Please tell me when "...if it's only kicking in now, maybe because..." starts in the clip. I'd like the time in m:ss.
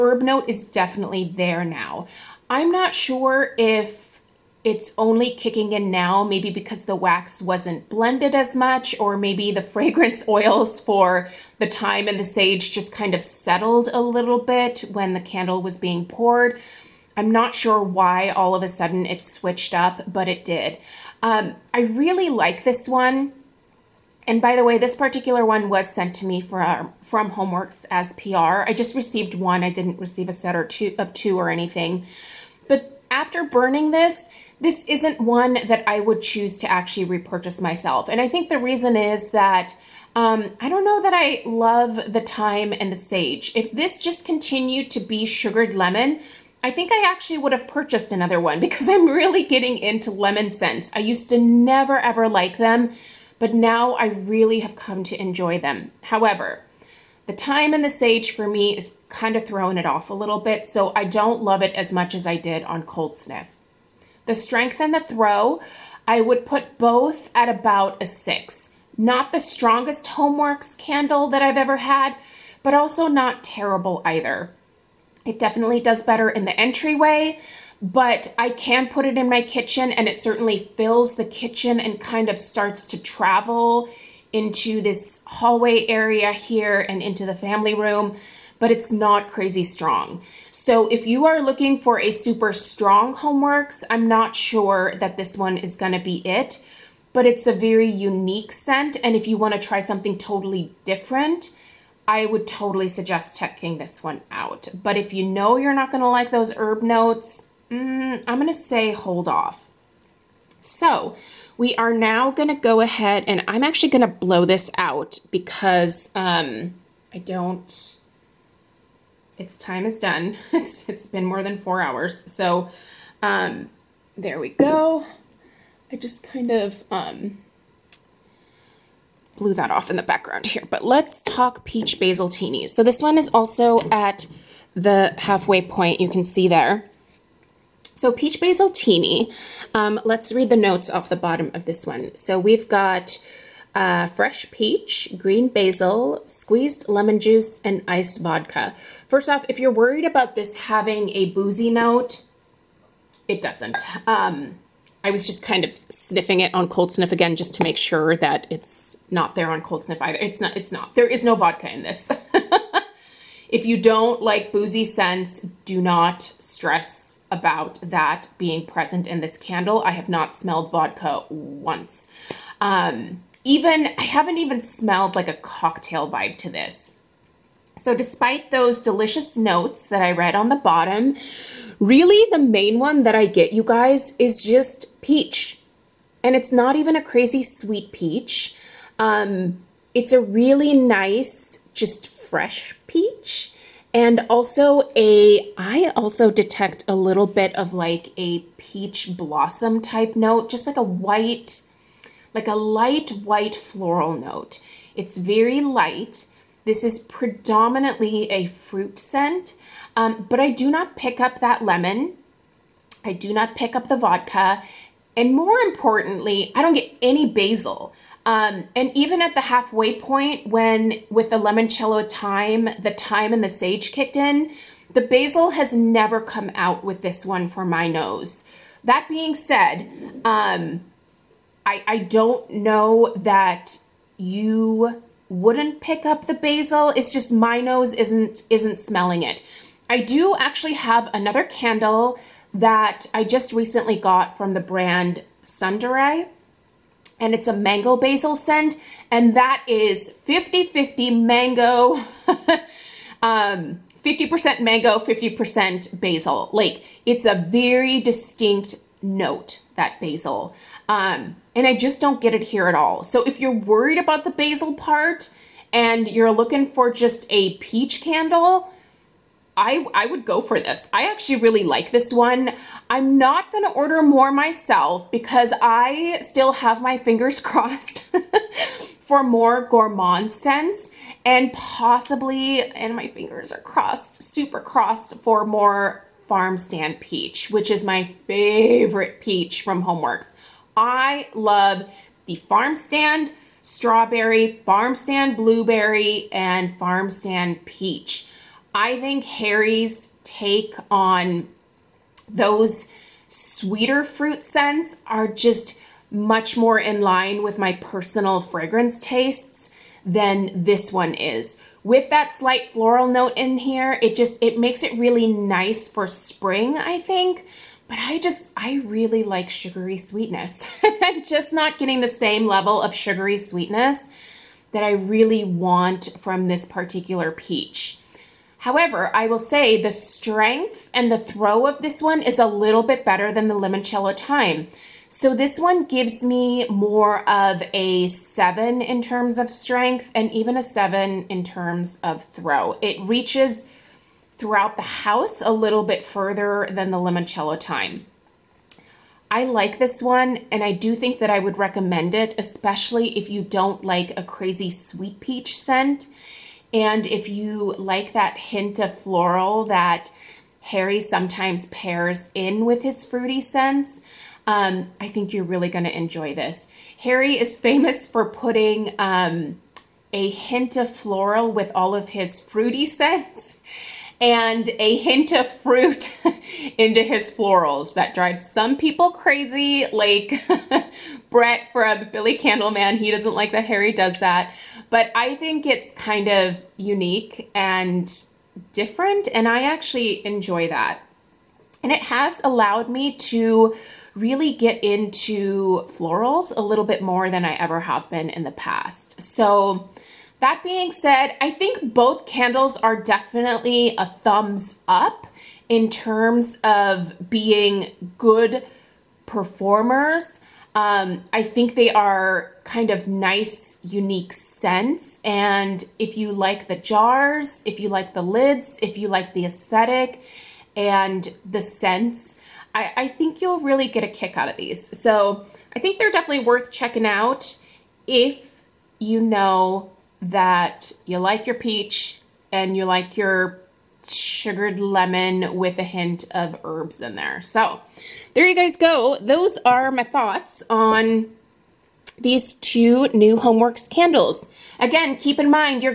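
0:03.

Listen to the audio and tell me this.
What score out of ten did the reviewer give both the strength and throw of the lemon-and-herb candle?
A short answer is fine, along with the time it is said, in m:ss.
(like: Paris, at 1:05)
6, at 1:07.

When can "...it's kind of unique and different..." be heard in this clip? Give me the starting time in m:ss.
6:25.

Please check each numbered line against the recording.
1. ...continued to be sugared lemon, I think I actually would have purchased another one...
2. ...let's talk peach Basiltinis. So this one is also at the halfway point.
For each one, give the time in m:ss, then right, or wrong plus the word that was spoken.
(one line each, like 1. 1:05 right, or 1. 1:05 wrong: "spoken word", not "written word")
1. 0:44 right
2. 2:10 right.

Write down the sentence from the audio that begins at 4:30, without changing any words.
I actually really like this one.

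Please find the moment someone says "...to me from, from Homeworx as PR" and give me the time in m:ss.
0:26.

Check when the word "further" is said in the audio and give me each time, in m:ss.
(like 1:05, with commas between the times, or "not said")
5:46.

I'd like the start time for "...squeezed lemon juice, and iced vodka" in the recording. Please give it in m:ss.
2:26.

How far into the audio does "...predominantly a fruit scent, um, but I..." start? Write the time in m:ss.
3:26.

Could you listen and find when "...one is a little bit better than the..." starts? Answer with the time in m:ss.
5:32.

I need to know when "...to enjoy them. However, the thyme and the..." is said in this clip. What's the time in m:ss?
0:55.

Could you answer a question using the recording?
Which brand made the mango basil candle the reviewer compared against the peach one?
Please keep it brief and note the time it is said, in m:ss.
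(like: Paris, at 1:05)
Sundaray, at 4:05.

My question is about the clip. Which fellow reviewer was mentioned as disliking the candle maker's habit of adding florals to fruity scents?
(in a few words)
Philly Candleman.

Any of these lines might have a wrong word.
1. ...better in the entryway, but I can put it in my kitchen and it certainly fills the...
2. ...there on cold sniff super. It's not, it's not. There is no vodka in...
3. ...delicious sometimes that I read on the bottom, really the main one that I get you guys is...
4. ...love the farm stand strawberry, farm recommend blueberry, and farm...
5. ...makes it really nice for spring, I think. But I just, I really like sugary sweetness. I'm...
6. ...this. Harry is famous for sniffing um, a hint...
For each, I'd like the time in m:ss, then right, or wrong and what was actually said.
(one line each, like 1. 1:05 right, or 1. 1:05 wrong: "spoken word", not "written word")
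1. 1:16 right
2. 2:39 wrong: "either", not "super"
3. 2:58 wrong: "notes", not "sometimes"
4. 4:51 wrong: "stand", not "recommend"
5. 5:14 right
6. 6:06 wrong: "putting", not "sniffing".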